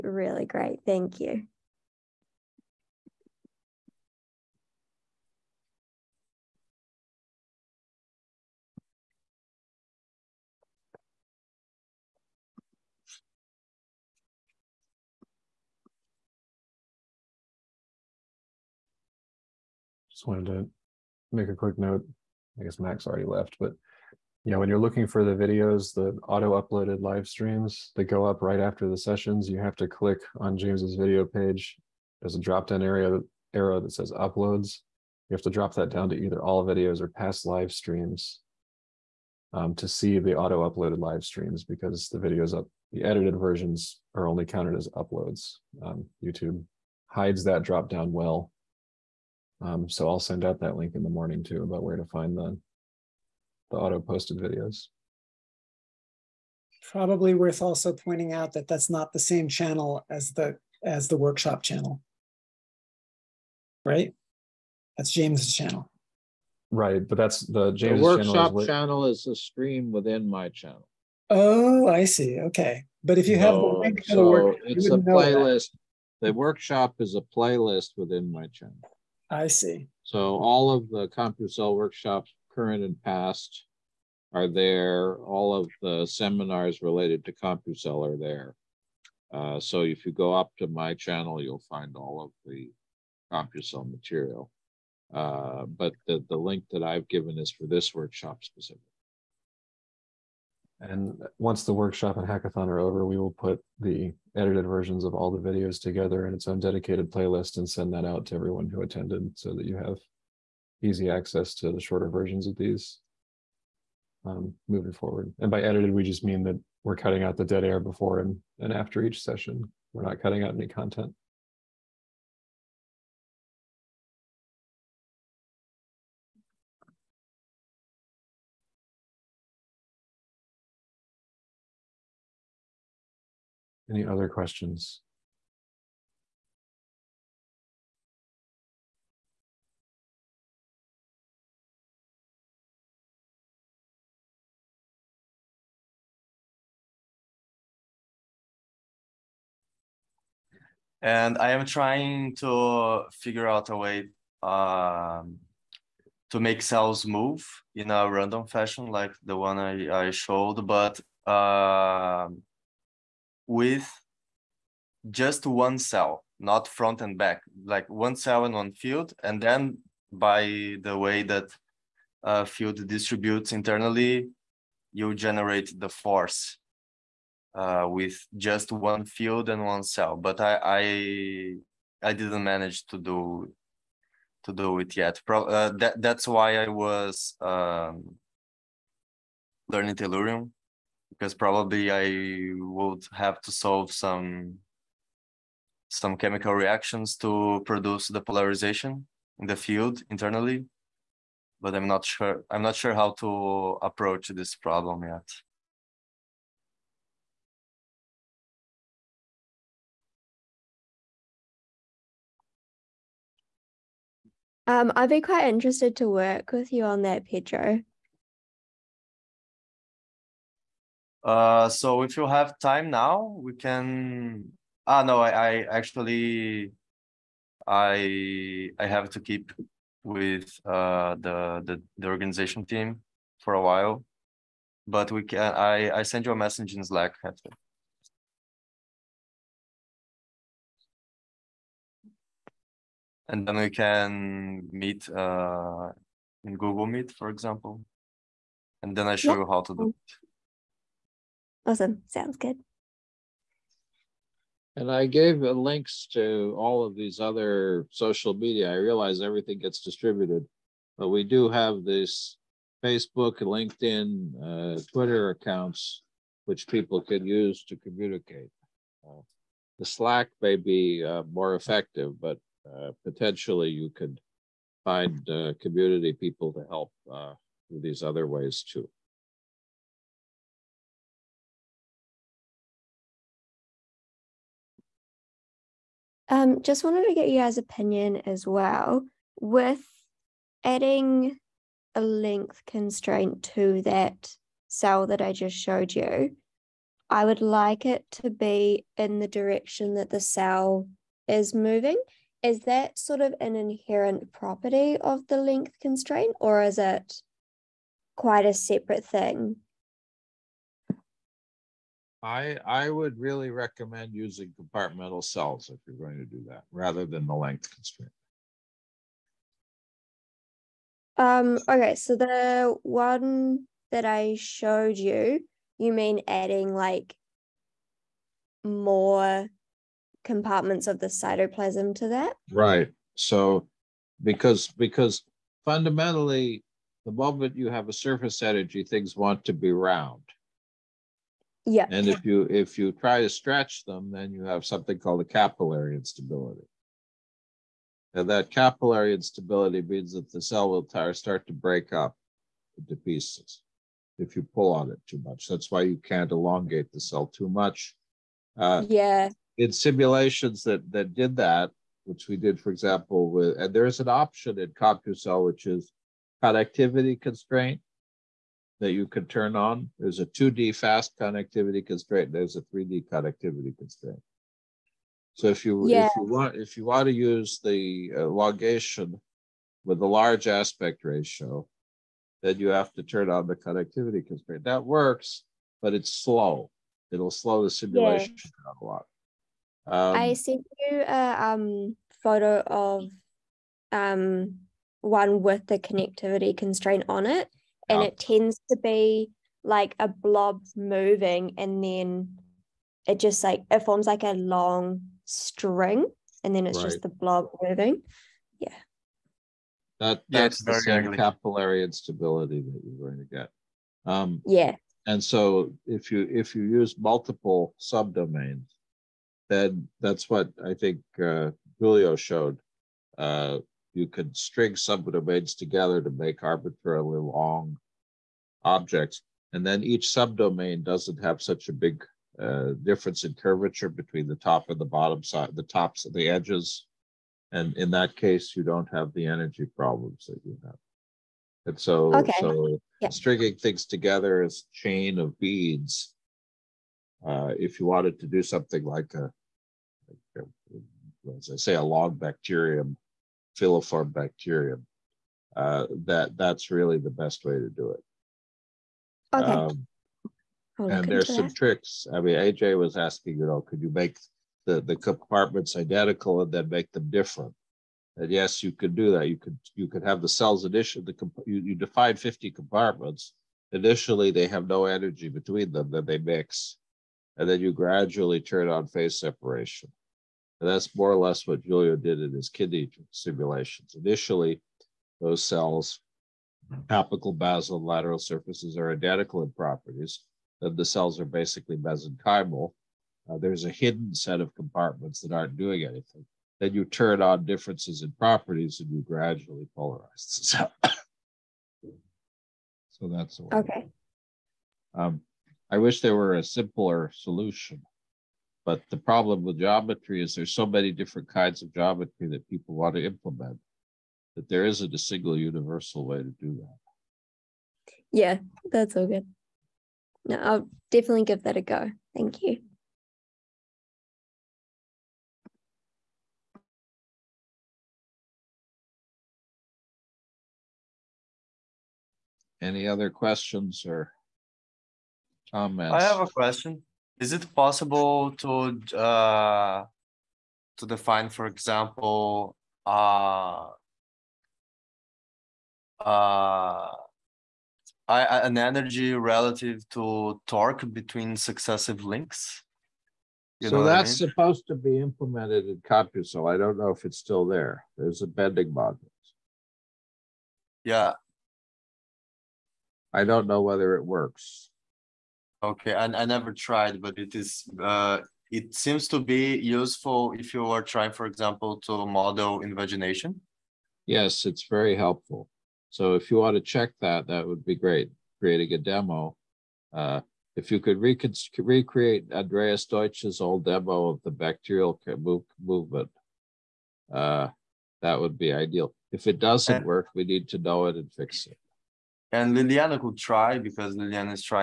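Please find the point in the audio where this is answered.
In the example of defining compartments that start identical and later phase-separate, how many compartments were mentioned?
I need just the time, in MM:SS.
07:52.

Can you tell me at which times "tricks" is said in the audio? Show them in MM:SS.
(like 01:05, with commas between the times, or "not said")
07:41.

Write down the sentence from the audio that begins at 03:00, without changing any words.
But I, I, I didn't manage to do to do it yet.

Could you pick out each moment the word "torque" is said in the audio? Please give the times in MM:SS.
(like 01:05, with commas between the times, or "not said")
09:10.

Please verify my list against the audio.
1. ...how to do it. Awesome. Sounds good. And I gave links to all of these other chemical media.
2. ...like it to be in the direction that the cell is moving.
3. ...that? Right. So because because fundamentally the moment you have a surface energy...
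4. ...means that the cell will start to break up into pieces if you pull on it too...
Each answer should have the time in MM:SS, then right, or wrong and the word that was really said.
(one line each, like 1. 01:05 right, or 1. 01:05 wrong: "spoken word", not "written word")
1. 04:09 wrong: "social", not "chemical"
2. 04:57 right
3. 05:32 right
4. 05:49 right.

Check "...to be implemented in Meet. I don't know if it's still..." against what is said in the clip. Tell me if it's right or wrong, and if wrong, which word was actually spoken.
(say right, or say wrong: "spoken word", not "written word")
wrong: "CompuCell", not "Meet".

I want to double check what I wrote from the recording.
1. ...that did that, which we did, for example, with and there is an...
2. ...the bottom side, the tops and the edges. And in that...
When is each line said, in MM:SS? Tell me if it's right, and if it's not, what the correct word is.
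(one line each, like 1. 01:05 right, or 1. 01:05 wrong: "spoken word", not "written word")
1. 06:00 right
2. 07:14 right.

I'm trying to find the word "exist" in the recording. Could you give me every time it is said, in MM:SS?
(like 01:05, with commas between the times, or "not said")
not said.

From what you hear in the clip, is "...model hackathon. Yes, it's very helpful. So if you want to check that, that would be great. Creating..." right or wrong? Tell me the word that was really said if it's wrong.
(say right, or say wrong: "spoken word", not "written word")
wrong: "invagination", not "hackathon".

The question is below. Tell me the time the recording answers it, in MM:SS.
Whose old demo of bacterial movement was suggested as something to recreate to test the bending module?
09:42.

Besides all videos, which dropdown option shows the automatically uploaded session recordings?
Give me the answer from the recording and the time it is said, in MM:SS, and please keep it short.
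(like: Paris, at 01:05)
past live streams, at 00:37.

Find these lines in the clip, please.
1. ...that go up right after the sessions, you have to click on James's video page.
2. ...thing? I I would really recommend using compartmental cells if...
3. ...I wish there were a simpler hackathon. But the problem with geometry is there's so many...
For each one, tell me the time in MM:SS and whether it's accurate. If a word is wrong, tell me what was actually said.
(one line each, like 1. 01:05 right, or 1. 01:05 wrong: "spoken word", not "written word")
1. 00:27 right
2. 05:09 right
3. 08:25 wrong: "solution", not "hackathon".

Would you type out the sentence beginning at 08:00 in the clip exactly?
And that's more or less what Julio did in his kidney simulations.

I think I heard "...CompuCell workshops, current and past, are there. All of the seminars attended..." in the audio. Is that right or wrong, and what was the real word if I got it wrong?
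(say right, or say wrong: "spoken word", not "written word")
wrong: "related", not "attended".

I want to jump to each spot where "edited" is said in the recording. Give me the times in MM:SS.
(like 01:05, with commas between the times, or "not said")
00:43, 01:44, 01:55.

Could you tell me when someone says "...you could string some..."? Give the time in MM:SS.
07:03.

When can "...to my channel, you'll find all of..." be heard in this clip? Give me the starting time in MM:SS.
01:30.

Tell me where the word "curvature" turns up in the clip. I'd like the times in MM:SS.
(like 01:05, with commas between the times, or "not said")
07:13.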